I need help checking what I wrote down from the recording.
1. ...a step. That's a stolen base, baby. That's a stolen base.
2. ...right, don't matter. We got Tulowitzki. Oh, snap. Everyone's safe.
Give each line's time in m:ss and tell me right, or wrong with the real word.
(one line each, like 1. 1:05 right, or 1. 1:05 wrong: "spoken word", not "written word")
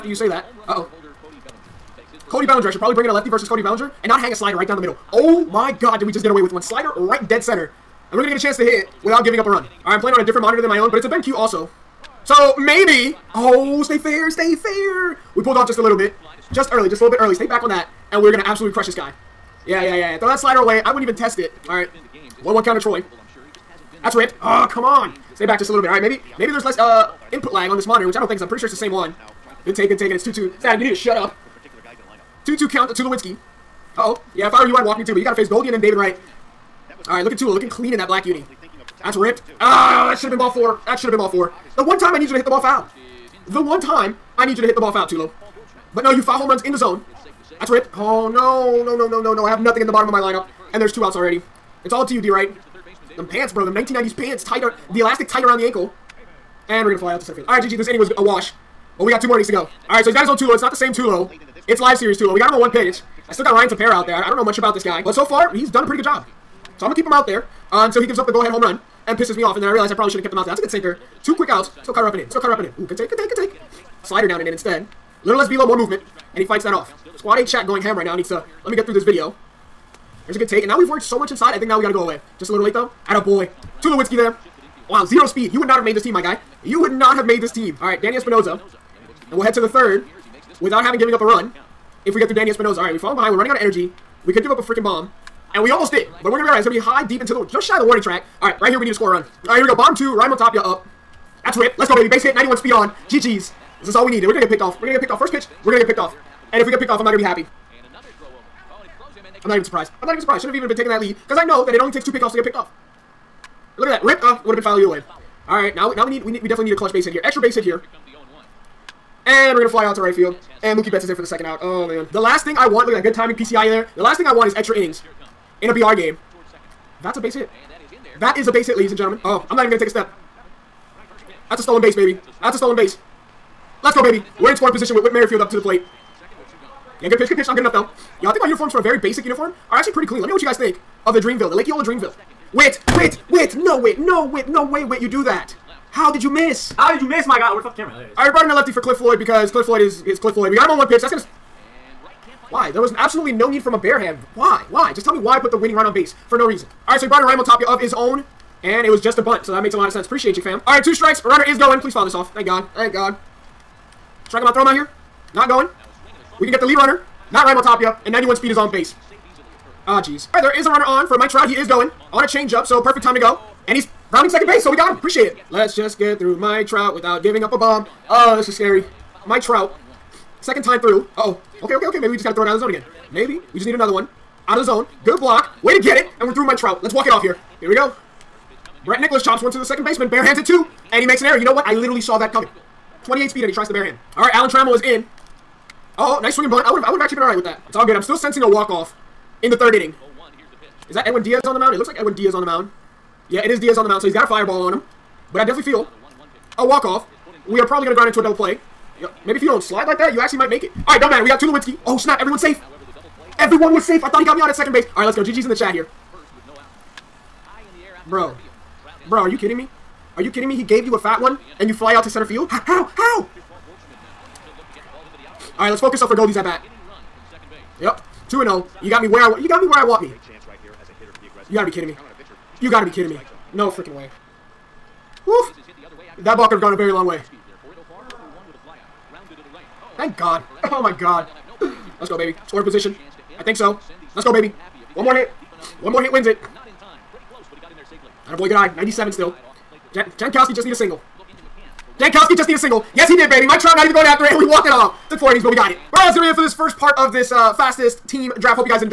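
1. 2:09 right
2. 3:30 right.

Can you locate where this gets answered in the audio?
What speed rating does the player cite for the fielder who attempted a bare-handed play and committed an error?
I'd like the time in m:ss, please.
3:13.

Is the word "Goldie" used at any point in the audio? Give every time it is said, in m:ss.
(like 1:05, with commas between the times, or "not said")
0:35, 3:46.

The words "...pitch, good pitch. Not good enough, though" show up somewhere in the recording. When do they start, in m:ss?
2:17.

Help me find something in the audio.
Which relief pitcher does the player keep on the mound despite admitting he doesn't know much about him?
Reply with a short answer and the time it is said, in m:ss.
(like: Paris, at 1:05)
Ryan Tepera, at 1:03.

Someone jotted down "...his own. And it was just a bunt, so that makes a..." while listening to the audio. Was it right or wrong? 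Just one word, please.
right.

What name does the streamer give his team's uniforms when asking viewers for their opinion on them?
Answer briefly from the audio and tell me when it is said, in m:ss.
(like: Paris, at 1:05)
Lake Eola Dreamville, at 2:21.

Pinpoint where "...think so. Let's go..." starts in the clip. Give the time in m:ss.
4:03.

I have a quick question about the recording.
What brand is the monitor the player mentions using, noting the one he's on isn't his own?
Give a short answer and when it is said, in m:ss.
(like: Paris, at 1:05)
BenQ, at 0:11.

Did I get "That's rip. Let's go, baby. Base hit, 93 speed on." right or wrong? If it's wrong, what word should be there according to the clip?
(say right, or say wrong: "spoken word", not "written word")
wrong: "91", not "93".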